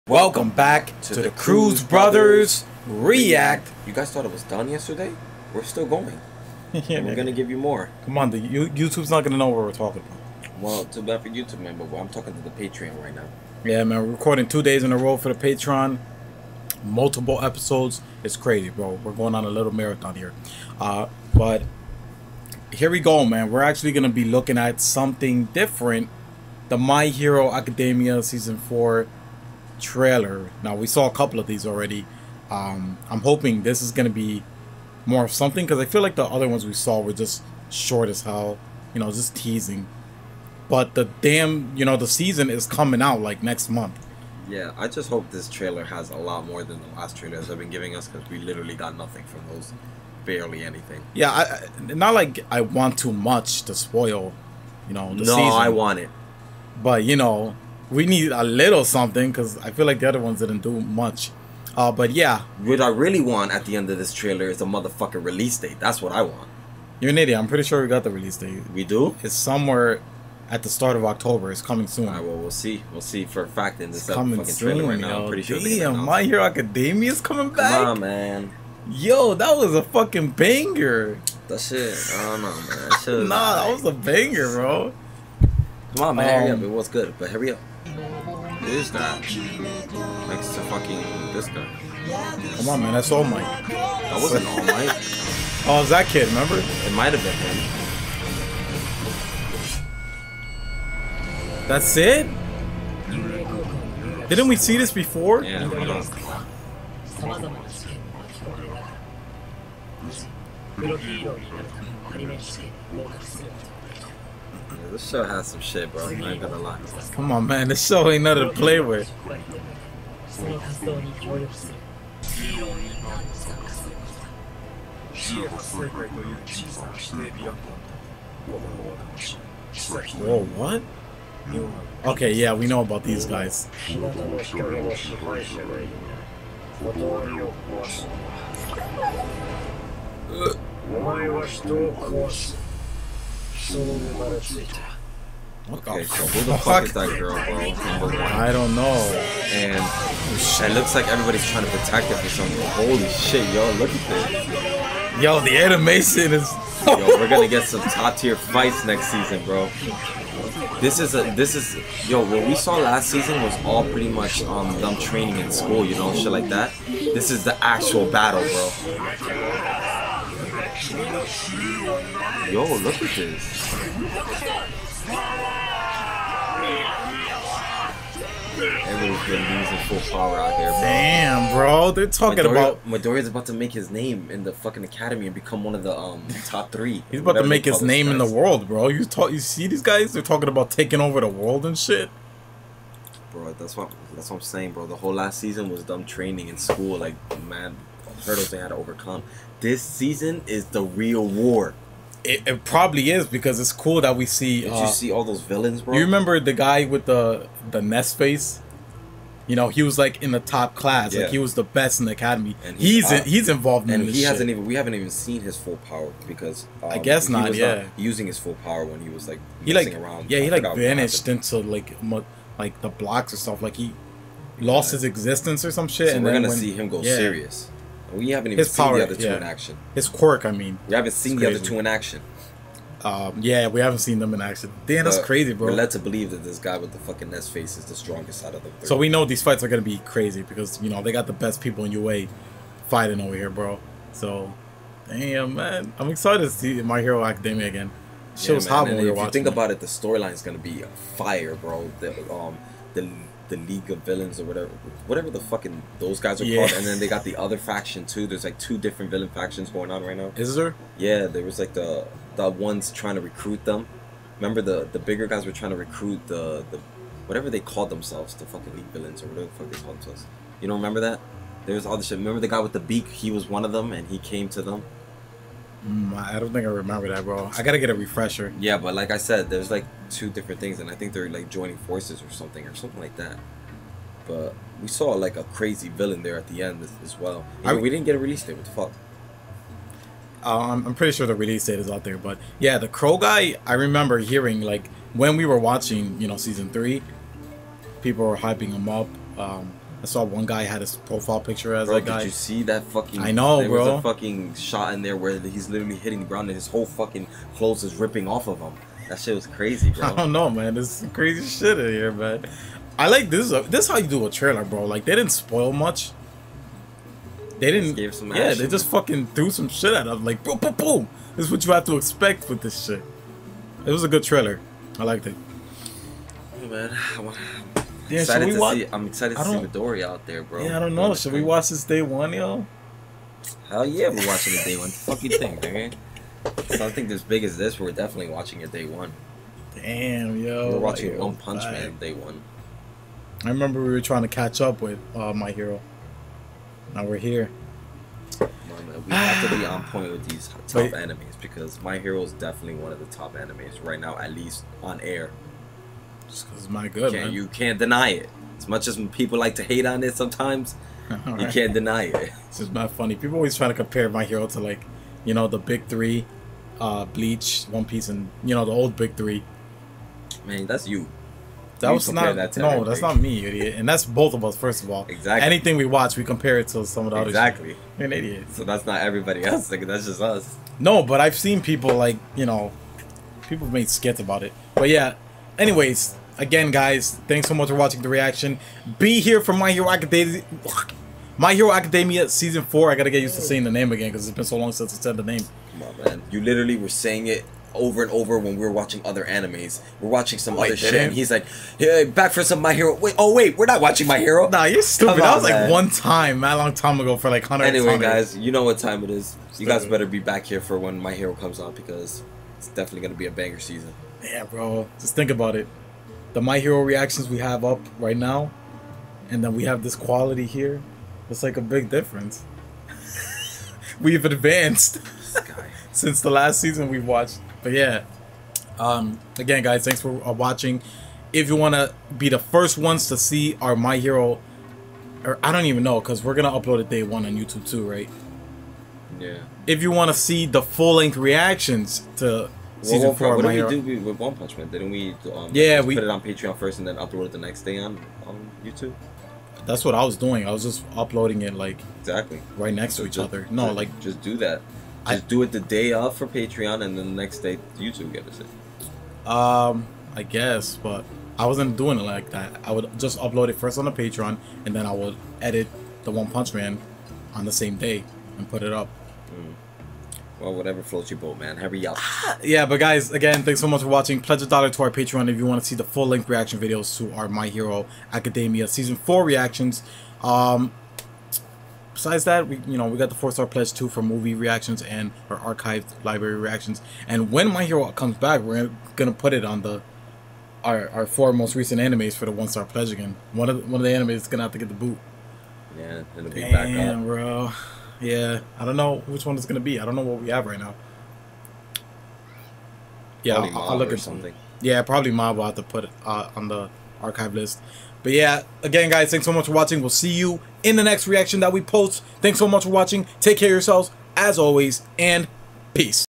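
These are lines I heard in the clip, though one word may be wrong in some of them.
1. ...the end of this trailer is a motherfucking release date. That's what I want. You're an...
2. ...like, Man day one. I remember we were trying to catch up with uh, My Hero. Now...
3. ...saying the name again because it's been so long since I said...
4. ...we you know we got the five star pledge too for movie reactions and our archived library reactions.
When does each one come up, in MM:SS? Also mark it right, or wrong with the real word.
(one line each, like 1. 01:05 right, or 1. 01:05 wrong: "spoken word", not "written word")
1. 01:03 right
2. 05:41 right
3. 06:33 right
4. 08:02 wrong: "four", not "five".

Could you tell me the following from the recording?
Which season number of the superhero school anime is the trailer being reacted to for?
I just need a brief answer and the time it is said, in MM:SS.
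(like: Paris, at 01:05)
Season four, at 00:28.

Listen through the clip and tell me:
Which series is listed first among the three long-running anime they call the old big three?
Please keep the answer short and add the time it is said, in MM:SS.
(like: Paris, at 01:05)
Bleach, at 06:07.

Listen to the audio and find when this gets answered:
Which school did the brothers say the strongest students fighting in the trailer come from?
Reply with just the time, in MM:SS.
04:01.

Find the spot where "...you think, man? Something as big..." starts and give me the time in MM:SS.
05:35.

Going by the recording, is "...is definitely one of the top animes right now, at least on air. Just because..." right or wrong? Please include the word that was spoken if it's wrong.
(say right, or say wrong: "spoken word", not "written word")
right.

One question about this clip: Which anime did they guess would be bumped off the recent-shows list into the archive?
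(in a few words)
Mob.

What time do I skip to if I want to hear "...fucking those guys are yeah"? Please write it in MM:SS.
04:15.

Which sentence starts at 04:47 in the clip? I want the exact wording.
I, we didn't get a release date.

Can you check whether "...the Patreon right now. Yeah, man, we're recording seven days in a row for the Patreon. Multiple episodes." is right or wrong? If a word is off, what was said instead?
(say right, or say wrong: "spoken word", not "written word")
wrong: "two", not "seven".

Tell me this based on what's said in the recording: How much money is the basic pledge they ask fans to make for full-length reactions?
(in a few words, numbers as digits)
a dollar.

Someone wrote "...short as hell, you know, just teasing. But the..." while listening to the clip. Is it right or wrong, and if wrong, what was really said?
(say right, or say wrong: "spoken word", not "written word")
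right.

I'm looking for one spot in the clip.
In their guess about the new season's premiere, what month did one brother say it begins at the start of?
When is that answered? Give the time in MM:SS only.
01:11.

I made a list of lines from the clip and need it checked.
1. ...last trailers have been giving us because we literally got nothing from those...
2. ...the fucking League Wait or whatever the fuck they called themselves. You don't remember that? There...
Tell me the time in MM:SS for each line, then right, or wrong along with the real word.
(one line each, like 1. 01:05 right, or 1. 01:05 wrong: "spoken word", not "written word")
1. 00:46 right
2. 04:28 wrong: "Villains", not "Wait".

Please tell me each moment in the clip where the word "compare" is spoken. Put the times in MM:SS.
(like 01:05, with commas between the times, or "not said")
06:03, 06:16.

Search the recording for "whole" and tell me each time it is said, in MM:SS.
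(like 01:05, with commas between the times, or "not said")
03:14, 05:06.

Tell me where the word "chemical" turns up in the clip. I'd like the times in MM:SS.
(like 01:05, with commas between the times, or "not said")
not said.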